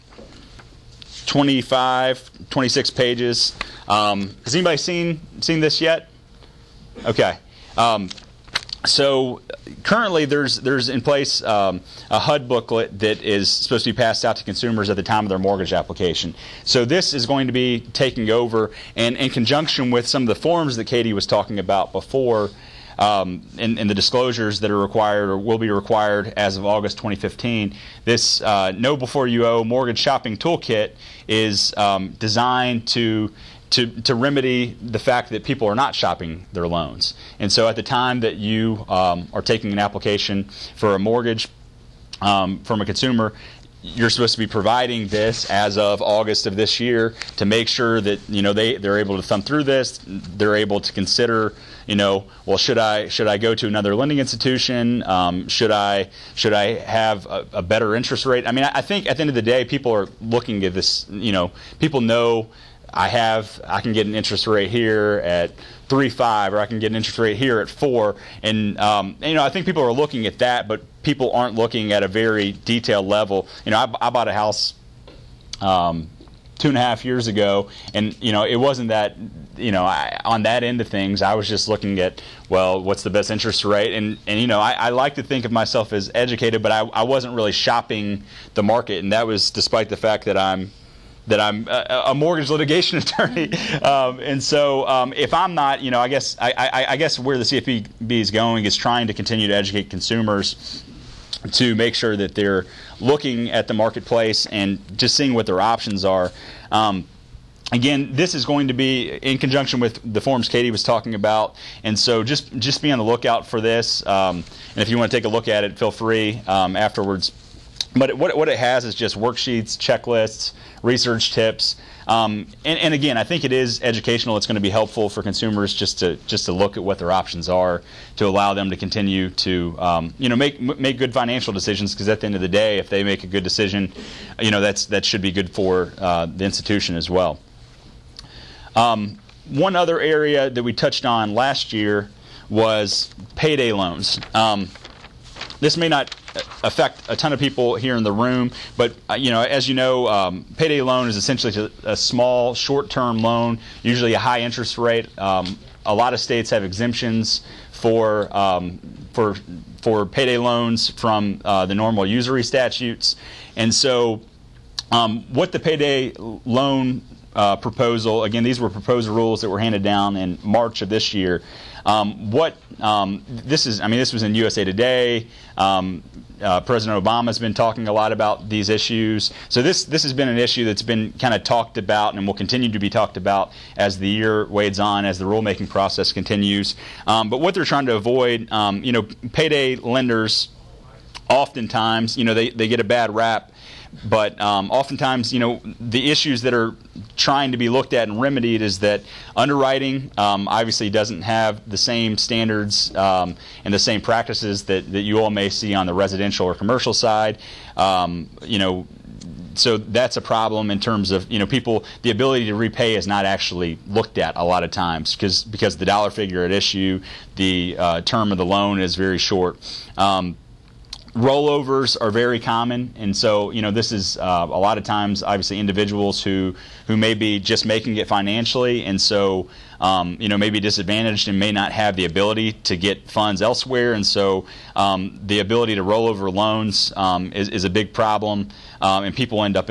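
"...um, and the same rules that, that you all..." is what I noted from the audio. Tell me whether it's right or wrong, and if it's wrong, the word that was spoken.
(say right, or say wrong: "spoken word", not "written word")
wrong: "practices", not "rules".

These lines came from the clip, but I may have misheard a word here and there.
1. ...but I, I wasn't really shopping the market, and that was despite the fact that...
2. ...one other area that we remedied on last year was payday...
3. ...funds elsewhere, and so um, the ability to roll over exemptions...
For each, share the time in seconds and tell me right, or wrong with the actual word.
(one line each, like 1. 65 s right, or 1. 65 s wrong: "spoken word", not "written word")
1. 86 s right
2. 139 s wrong: "touched", not "remedied"
3. 233 s wrong: "loans", not "exemptions".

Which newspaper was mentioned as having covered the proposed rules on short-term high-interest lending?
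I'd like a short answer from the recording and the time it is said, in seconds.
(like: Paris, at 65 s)
USA Today, at 174 s.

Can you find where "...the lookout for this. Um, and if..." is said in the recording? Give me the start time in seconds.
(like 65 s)
112 s.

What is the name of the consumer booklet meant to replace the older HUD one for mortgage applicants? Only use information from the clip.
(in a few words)
Know Before You Owe Mortgage Shopping Toolkit.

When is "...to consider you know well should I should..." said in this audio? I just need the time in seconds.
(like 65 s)
50 s.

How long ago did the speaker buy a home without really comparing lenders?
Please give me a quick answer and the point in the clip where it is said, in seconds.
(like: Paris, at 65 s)
two and a half years, at 76 s.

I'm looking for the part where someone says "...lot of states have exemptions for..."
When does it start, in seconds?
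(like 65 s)
155 s.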